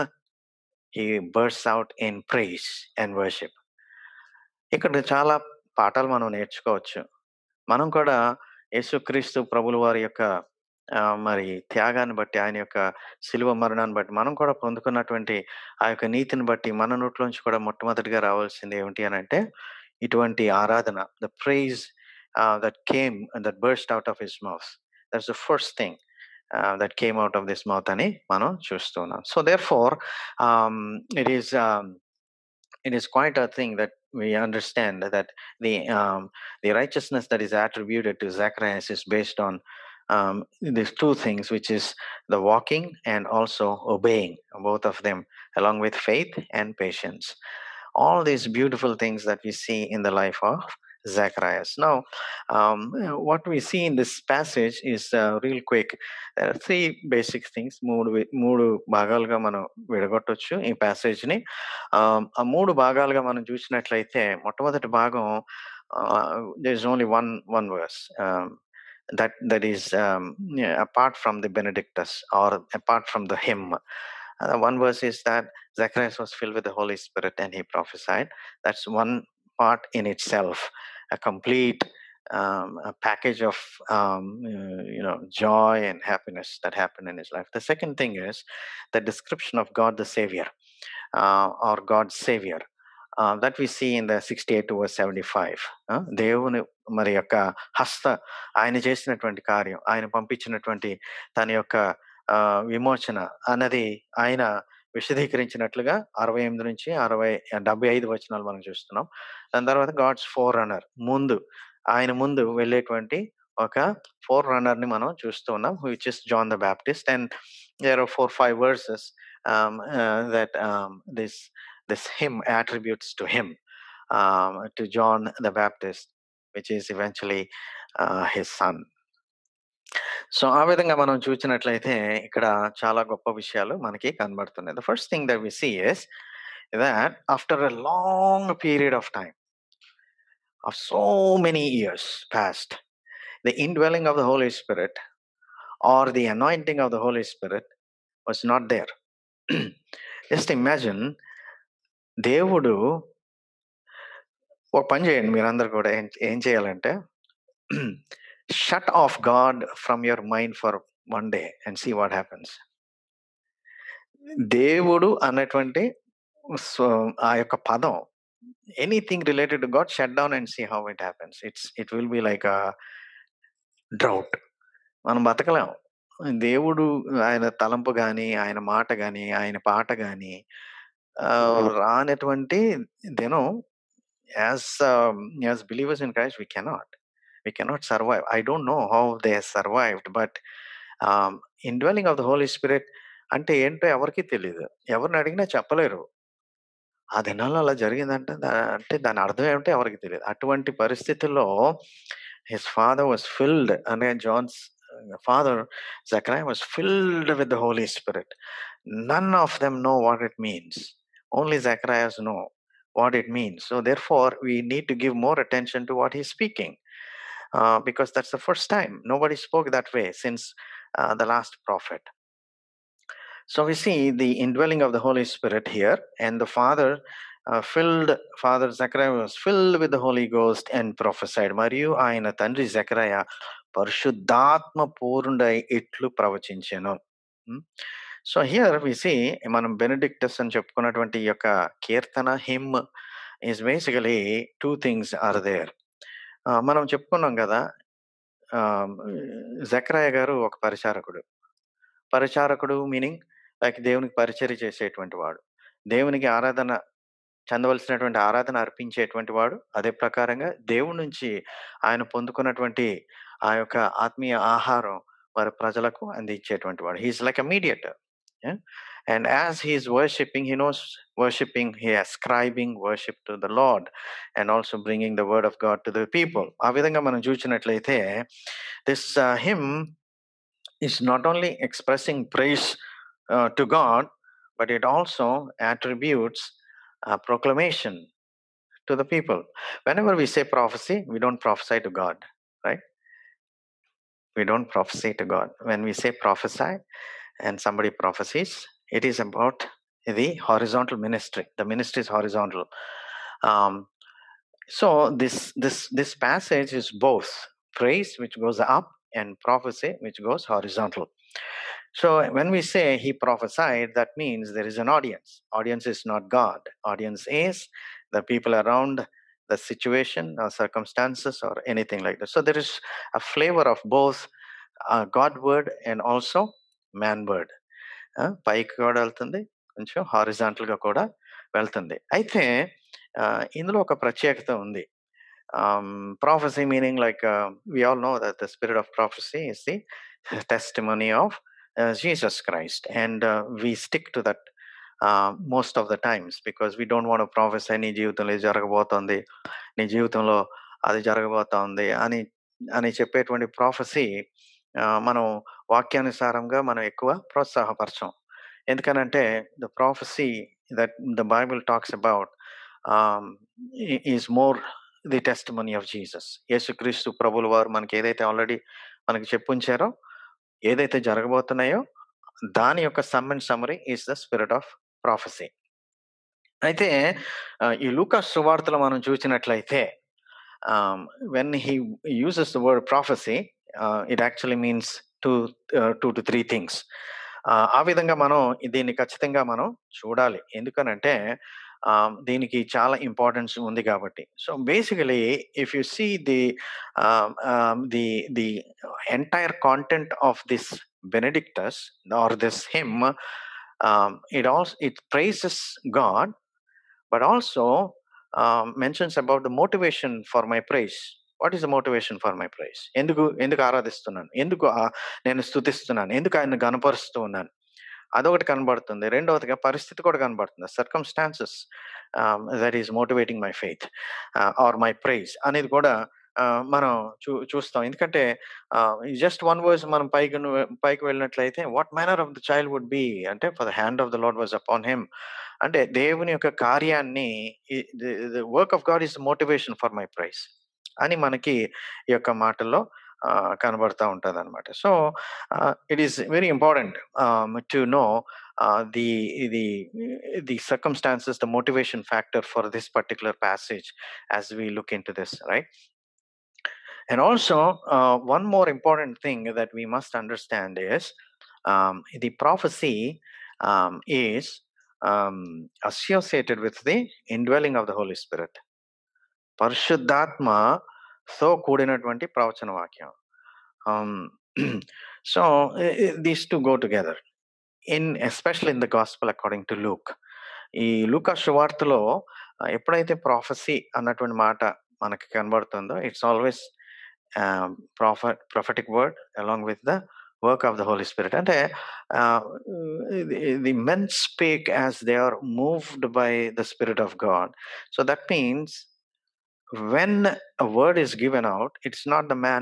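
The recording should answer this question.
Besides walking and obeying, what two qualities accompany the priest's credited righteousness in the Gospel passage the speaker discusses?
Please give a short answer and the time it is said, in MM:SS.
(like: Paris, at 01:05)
faith and patience, at 00:46.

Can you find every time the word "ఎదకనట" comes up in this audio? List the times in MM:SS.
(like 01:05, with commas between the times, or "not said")
05:58, 06:30.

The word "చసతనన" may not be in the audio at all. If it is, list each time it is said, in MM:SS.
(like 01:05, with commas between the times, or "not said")
00:28, 01:48.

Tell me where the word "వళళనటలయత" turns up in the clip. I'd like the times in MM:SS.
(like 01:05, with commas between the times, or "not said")
07:11.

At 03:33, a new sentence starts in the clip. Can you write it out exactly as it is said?
So, therefore, we need to give more attention to what he's speaking.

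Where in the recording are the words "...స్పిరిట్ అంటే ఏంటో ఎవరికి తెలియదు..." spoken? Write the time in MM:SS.
03:12.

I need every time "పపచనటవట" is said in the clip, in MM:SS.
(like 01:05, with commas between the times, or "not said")
01:40.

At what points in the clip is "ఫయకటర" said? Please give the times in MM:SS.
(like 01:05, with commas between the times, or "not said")
07:32.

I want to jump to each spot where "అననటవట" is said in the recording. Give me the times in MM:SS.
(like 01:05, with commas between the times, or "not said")
02:45, 08:03.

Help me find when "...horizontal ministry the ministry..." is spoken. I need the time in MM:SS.
05:00.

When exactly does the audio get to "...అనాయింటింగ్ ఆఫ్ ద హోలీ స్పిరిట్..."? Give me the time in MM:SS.
02:26.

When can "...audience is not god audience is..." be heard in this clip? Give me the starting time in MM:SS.
05:15.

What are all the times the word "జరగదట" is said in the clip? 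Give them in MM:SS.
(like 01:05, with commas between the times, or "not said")
03:17.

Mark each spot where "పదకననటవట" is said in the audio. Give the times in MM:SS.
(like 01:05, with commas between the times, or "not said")
00:14, 04:22.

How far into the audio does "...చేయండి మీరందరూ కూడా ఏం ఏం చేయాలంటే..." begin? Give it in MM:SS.
02:35.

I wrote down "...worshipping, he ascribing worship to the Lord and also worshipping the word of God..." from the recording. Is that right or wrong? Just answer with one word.
wrong.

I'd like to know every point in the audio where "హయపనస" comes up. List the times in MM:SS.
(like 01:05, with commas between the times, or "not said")
02:42, 02:51.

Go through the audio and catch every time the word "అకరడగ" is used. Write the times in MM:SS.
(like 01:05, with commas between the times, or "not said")
07:59.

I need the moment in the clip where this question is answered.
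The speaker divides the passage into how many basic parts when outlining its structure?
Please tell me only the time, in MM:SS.
00:56.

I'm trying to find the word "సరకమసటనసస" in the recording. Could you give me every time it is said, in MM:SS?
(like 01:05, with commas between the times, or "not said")
07:00, 07:30.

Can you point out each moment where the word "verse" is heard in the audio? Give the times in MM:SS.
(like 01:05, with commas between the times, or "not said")
01:07, 01:14, 01:34.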